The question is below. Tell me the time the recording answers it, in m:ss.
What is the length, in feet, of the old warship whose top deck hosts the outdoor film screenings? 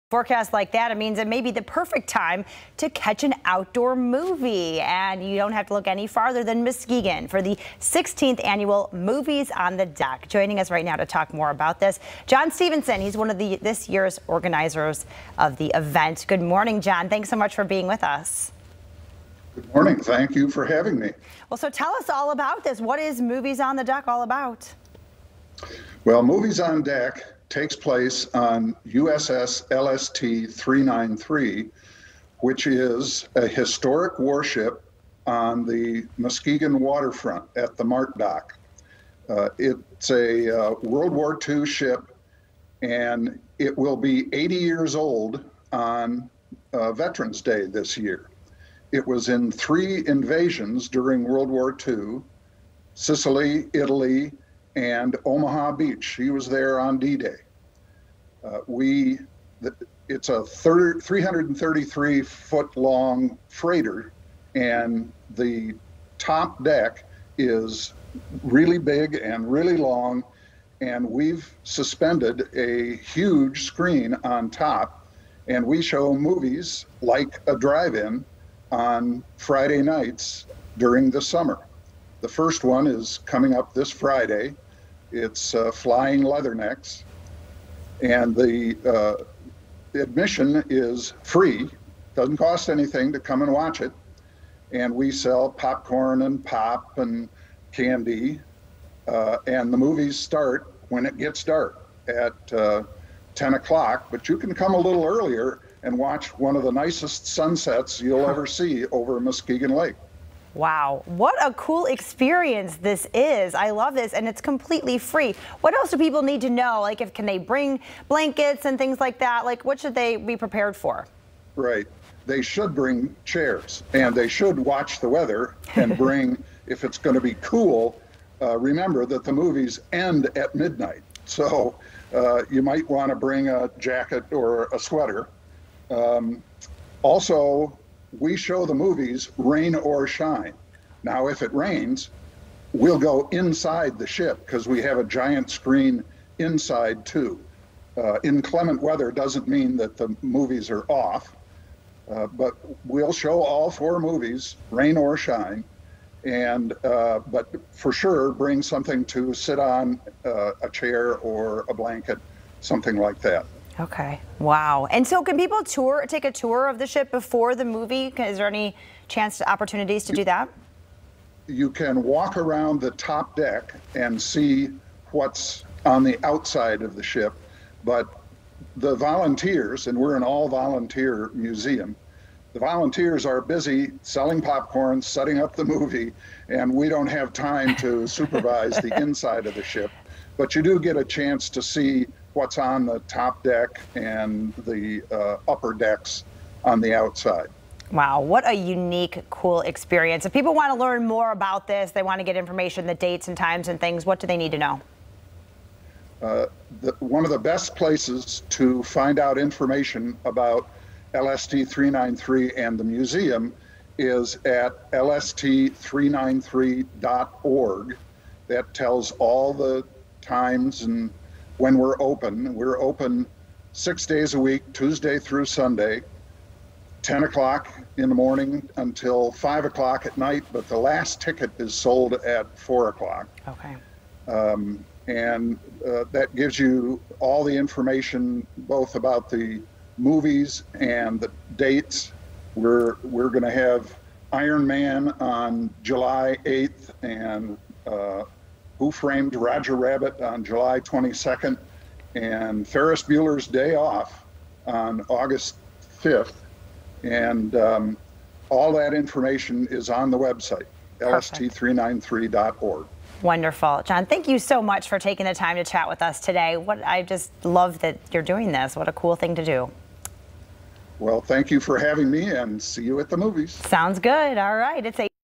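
1:00.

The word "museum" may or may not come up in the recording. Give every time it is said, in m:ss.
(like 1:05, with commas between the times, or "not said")
3:01, 3:32.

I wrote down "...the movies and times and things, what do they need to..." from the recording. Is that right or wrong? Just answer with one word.
wrong.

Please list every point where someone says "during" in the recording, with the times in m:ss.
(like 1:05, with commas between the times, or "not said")
0:50, 1:20.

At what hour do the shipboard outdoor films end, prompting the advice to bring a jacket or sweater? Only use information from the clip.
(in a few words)
Midnight.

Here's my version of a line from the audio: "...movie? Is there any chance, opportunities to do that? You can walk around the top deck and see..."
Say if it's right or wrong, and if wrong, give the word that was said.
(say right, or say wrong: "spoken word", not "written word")
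right.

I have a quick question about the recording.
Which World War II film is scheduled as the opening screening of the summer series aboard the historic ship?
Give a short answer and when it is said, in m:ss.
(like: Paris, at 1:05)
Flying Leathernecks, at 1:25.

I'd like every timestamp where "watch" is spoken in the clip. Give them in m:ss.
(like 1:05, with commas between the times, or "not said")
1:33, 1:45, 2:04.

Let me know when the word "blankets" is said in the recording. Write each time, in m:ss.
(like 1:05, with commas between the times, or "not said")
1:58, 2:41.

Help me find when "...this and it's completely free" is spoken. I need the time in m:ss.
1:53.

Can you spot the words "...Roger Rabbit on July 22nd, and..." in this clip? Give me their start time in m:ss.
4:09.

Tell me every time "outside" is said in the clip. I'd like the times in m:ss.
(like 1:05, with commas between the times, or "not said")
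2:56, 3:16.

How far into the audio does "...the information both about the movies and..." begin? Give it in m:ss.
3:57.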